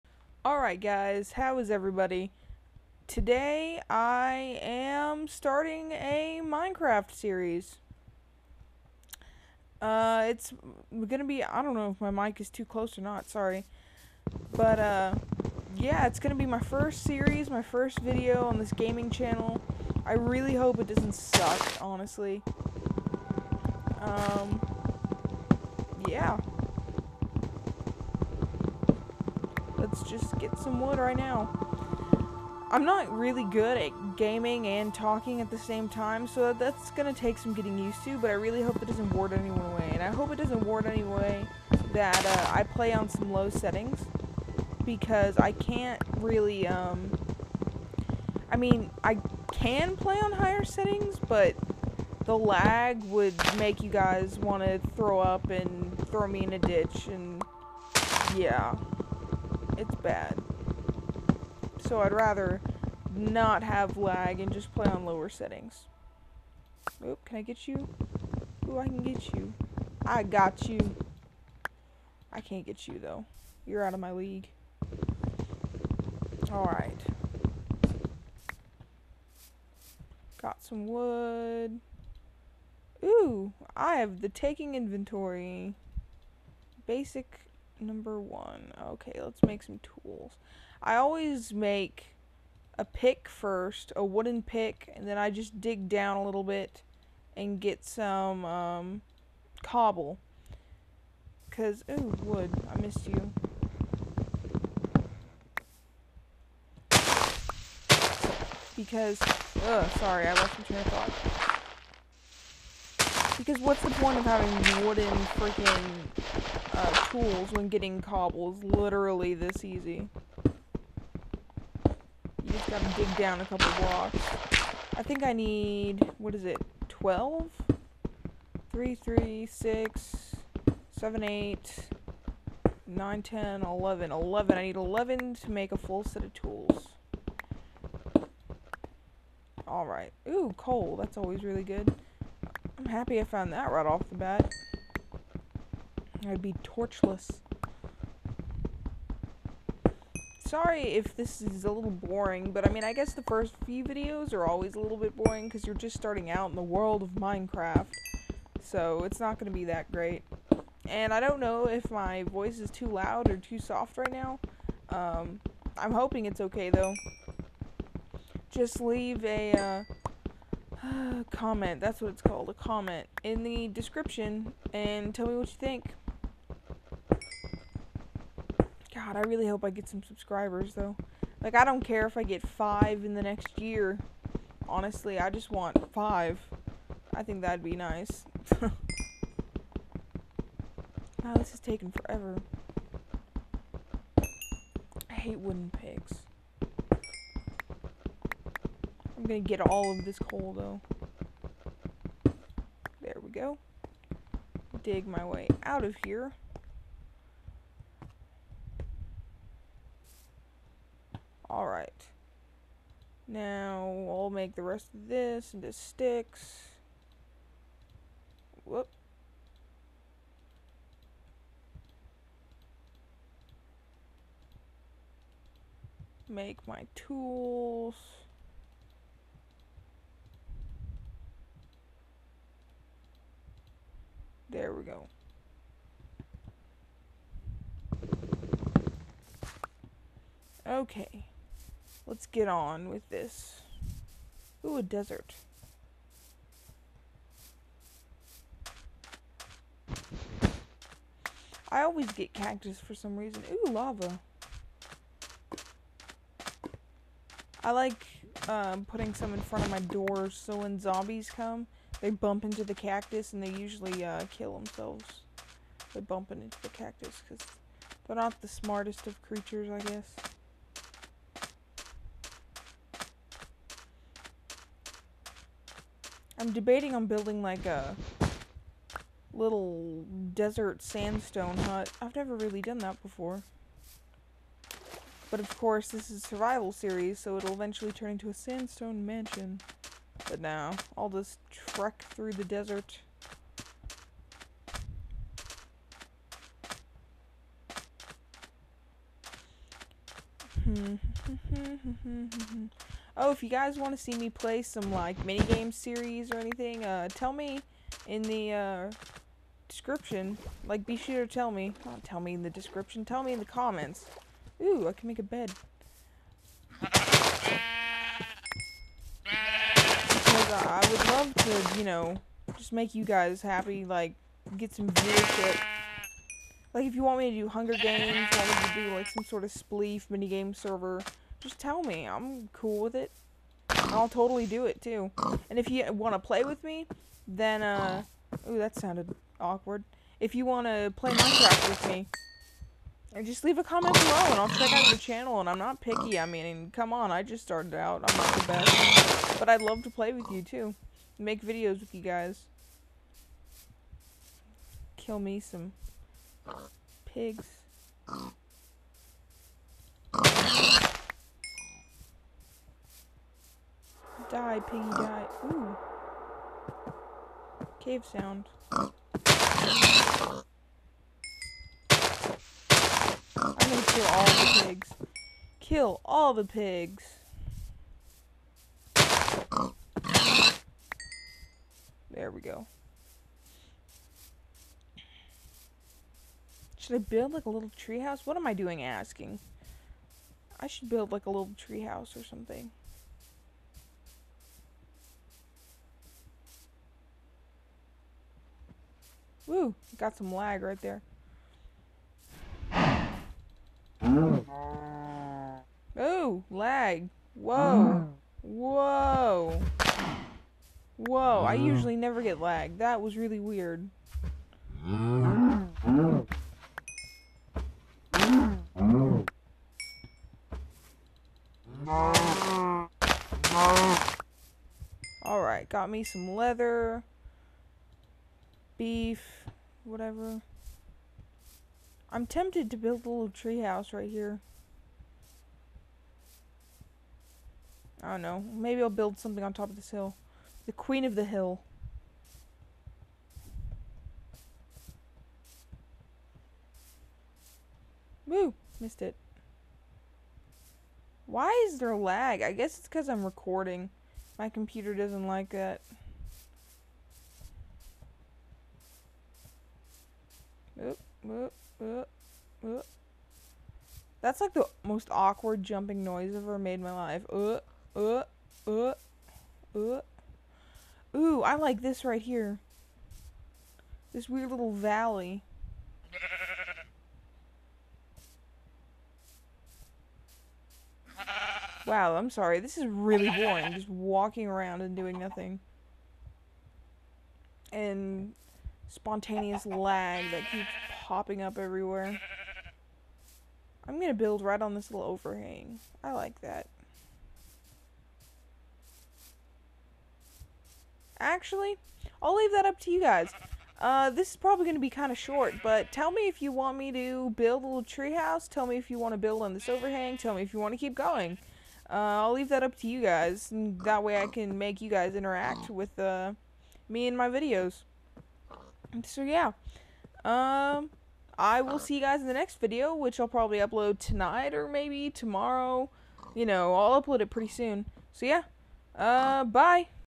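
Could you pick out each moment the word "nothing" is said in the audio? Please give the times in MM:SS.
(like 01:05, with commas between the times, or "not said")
08:05.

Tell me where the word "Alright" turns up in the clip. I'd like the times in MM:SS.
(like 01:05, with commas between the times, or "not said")
00:00, 01:16, 02:19, 03:31, 07:05.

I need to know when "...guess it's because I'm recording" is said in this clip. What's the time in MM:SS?
07:32.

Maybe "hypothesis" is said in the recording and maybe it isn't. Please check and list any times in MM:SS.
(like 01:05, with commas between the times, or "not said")
not said.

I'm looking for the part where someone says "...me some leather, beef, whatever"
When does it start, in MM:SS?
07:05.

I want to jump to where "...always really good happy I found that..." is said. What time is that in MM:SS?
02:21.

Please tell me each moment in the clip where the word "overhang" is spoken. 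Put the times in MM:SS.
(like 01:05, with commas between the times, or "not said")
08:15, 08:29.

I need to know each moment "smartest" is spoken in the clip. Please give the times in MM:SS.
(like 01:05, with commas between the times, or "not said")
04:28.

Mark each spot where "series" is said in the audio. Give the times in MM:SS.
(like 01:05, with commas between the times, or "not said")
00:07, 00:17, 04:46, 05:05.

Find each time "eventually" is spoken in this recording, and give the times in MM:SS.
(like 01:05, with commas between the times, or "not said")
04:47.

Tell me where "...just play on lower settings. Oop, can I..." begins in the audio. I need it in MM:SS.
01:04.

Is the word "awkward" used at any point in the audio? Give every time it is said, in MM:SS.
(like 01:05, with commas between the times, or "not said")
05:39, 07:45.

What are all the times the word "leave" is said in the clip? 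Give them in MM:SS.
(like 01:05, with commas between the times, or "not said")
02:48, 05:43, 08:22, 08:32.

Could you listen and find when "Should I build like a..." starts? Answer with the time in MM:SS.
06:26.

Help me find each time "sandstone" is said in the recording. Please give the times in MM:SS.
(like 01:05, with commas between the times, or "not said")
04:40, 04:48.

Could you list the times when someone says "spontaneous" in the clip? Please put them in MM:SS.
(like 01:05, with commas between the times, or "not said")
08:08.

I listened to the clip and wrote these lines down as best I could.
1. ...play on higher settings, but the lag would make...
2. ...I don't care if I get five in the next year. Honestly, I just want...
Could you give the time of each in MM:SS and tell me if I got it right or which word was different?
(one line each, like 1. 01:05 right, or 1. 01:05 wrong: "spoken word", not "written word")
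1. 00:49 right
2. 03:01 right.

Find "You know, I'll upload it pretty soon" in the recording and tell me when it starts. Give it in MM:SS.
08:46.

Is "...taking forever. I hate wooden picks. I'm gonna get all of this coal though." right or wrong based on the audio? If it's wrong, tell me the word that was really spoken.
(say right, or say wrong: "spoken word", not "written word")
right.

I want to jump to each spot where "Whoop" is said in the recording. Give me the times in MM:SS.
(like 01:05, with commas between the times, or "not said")
03:38.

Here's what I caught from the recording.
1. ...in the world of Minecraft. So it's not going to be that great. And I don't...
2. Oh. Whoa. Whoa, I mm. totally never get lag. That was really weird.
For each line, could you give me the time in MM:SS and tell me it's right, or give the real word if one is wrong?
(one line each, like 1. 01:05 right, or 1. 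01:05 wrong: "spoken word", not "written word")
1. 02:36 right
2. 06:47 wrong: "usually", not "totally".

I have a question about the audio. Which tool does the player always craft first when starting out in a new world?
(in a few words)
a wooden pick.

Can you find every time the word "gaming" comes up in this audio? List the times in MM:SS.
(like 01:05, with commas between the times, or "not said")
00:18, 00:34.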